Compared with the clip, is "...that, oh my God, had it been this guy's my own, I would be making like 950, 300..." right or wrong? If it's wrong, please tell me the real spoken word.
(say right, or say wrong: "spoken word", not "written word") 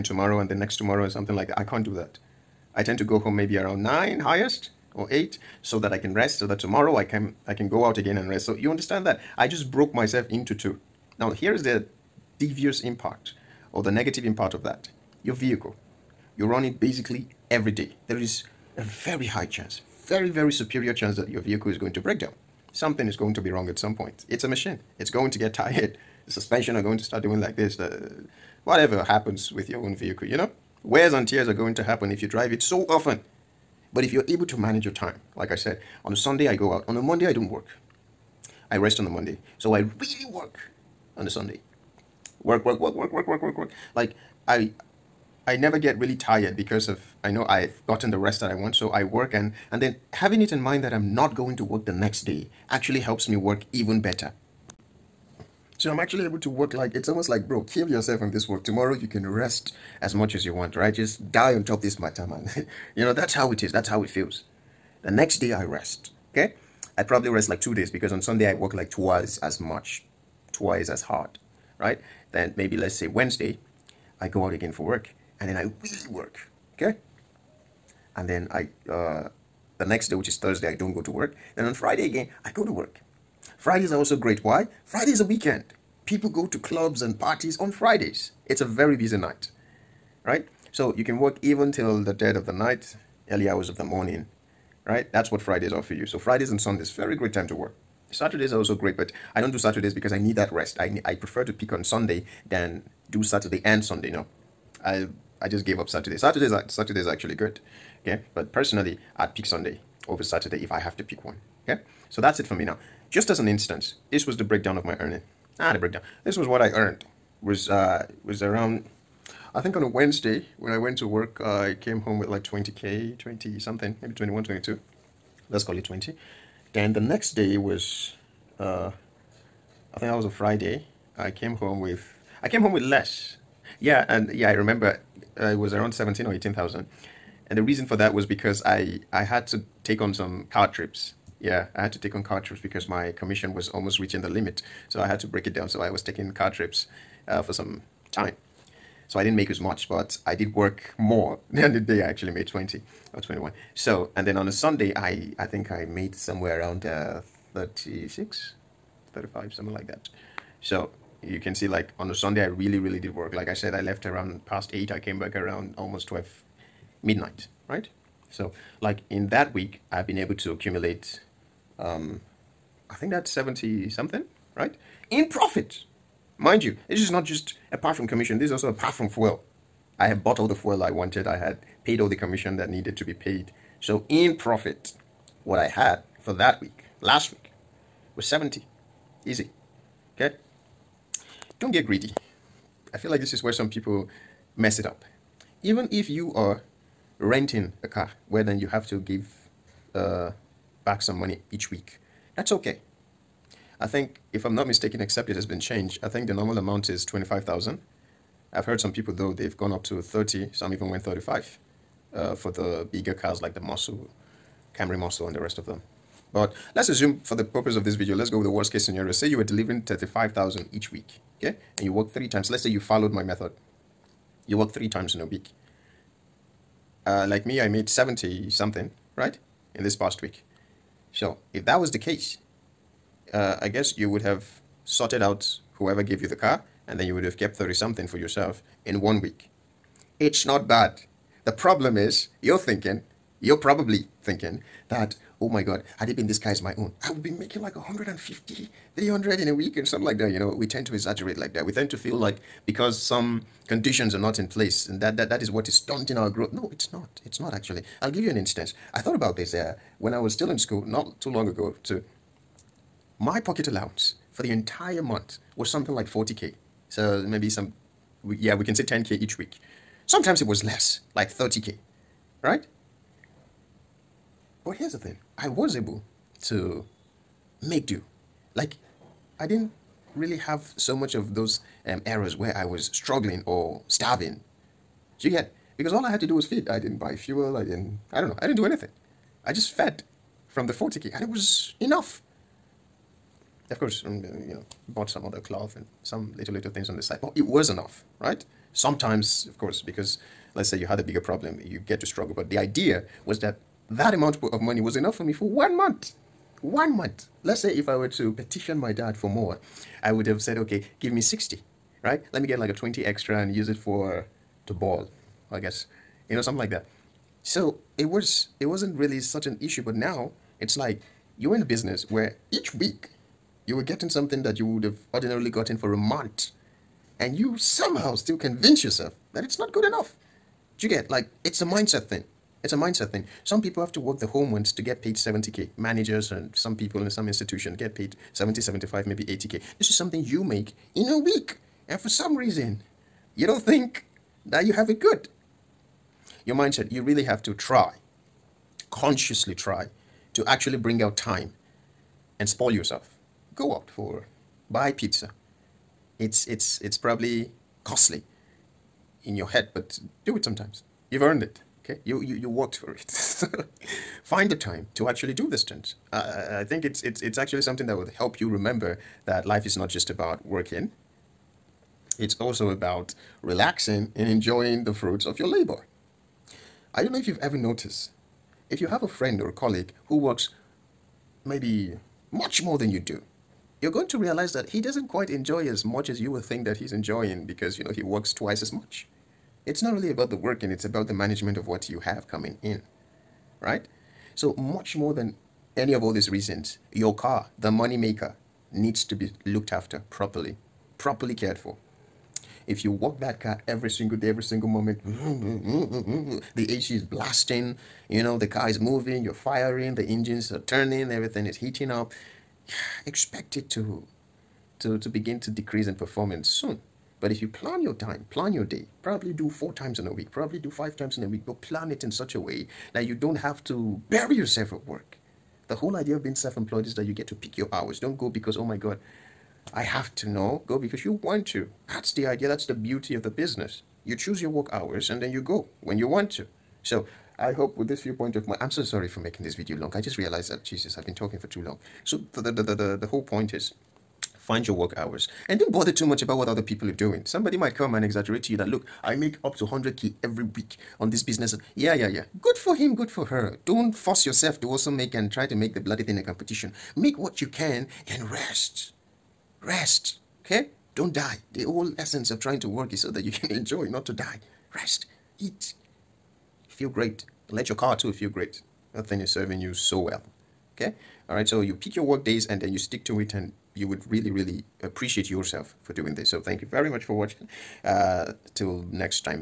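wrong: "150", not "950".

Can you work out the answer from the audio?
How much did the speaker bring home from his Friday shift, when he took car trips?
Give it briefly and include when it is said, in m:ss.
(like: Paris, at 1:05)
17 or 18,000, at 2:15.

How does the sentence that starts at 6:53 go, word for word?
Expect it to to to begin to decrease in performance soon.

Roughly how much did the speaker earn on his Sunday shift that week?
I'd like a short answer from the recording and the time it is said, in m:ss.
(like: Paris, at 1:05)
36, at 2:37.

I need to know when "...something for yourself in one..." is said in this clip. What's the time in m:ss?
3:57.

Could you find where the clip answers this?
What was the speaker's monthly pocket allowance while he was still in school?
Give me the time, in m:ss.
4:26.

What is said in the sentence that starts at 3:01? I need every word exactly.
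I had paid all the commission that needed to be paid.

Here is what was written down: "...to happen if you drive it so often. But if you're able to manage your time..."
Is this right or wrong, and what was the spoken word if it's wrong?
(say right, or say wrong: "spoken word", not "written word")
right.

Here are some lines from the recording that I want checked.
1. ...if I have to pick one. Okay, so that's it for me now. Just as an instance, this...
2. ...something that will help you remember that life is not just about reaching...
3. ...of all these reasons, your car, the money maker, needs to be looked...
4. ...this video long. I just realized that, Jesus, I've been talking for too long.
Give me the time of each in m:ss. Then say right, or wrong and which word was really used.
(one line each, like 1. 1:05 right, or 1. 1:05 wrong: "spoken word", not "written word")
1. 1:50 right
2. 6:07 wrong: "working", not "reaching"
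3. 6:35 right
4. 7:19 right.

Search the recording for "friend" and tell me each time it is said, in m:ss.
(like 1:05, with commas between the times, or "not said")
6:19.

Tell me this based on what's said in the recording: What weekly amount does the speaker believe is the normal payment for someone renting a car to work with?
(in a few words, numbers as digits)
25,000.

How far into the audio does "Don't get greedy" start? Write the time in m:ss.
3:11.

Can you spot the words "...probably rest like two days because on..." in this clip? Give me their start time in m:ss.
1:07.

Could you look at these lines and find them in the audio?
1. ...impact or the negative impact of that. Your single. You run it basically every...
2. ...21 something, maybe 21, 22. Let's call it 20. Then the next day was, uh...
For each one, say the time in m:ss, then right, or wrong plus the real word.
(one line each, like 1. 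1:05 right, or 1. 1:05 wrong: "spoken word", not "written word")
1. 0:12 wrong: "vehicle", not "single"
2. 2:03 wrong: "20", not "21".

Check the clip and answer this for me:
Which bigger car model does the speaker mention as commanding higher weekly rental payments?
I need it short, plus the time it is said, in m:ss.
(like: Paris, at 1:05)
Camry Muscle, at 3:34.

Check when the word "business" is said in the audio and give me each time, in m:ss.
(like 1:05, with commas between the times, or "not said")
5:21, 7:13, 7:31.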